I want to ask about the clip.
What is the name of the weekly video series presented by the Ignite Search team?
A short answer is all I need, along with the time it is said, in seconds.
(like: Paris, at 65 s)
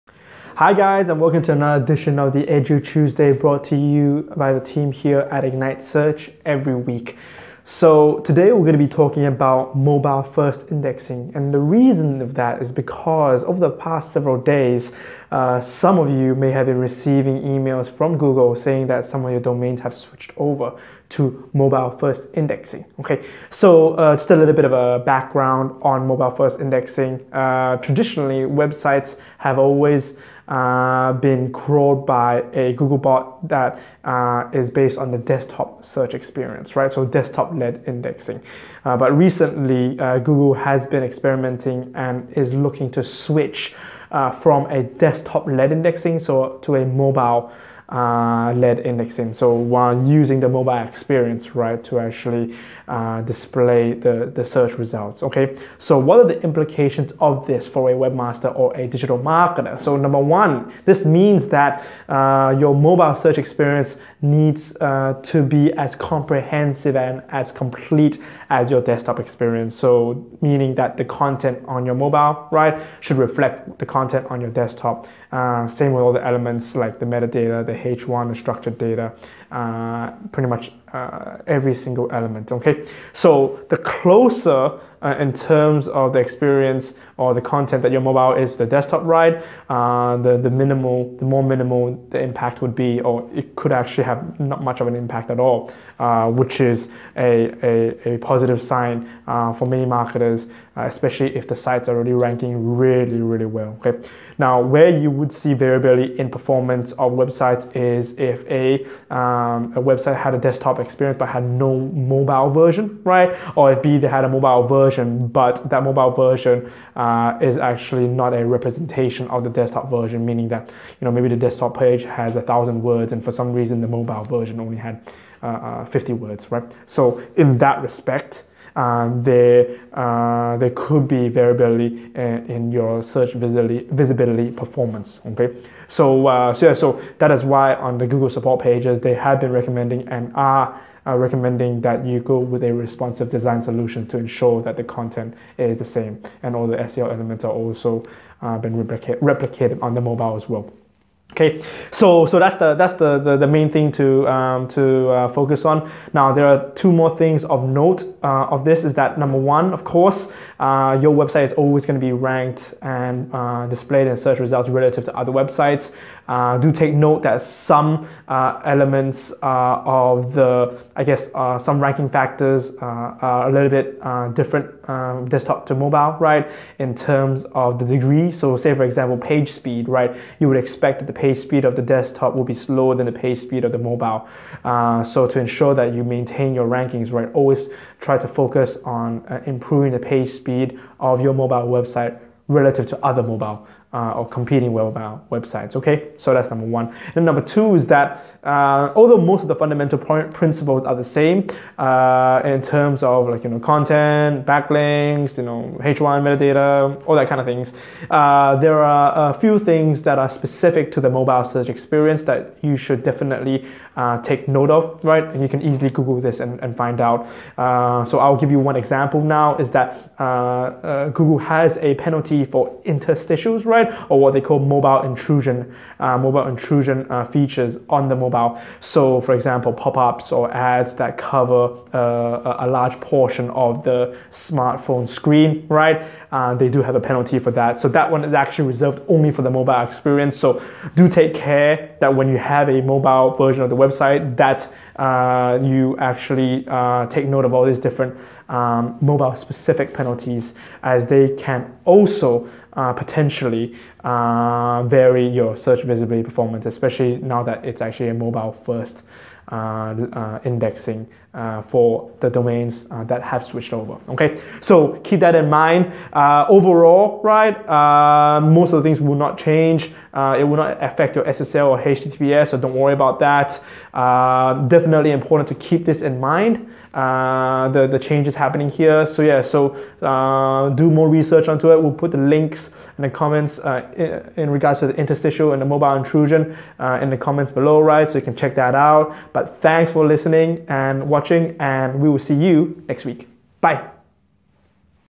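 EduTuesday, at 2 s.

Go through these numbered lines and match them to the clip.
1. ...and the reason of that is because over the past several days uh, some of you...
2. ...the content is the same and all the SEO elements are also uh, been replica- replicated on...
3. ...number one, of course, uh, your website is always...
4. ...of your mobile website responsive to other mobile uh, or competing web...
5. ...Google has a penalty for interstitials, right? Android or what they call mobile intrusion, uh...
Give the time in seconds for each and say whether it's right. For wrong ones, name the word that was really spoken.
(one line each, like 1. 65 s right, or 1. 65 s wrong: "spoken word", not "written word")
1. 11 s right
2. 144 s right
3. 159 s right
4. 190 s wrong: "relative", not "responsive"
5. 221 s right.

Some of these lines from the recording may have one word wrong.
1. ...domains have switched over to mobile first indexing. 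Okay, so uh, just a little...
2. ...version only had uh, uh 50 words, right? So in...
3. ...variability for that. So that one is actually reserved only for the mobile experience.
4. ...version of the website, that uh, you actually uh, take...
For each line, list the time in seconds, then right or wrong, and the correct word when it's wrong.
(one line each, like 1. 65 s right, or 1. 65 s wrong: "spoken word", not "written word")
1. 19 s right
2. 124 s right
3. 236 s wrong: "penalty", not "variability"
4. 243 s right.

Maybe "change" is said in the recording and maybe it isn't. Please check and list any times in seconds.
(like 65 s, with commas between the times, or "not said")
269 s, 277 s.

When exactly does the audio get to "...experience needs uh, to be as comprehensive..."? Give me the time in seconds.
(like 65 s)
63 s.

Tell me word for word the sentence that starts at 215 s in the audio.
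And you can easily Google this and, and find out.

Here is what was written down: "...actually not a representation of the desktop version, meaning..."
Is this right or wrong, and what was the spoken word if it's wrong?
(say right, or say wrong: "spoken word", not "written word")
right.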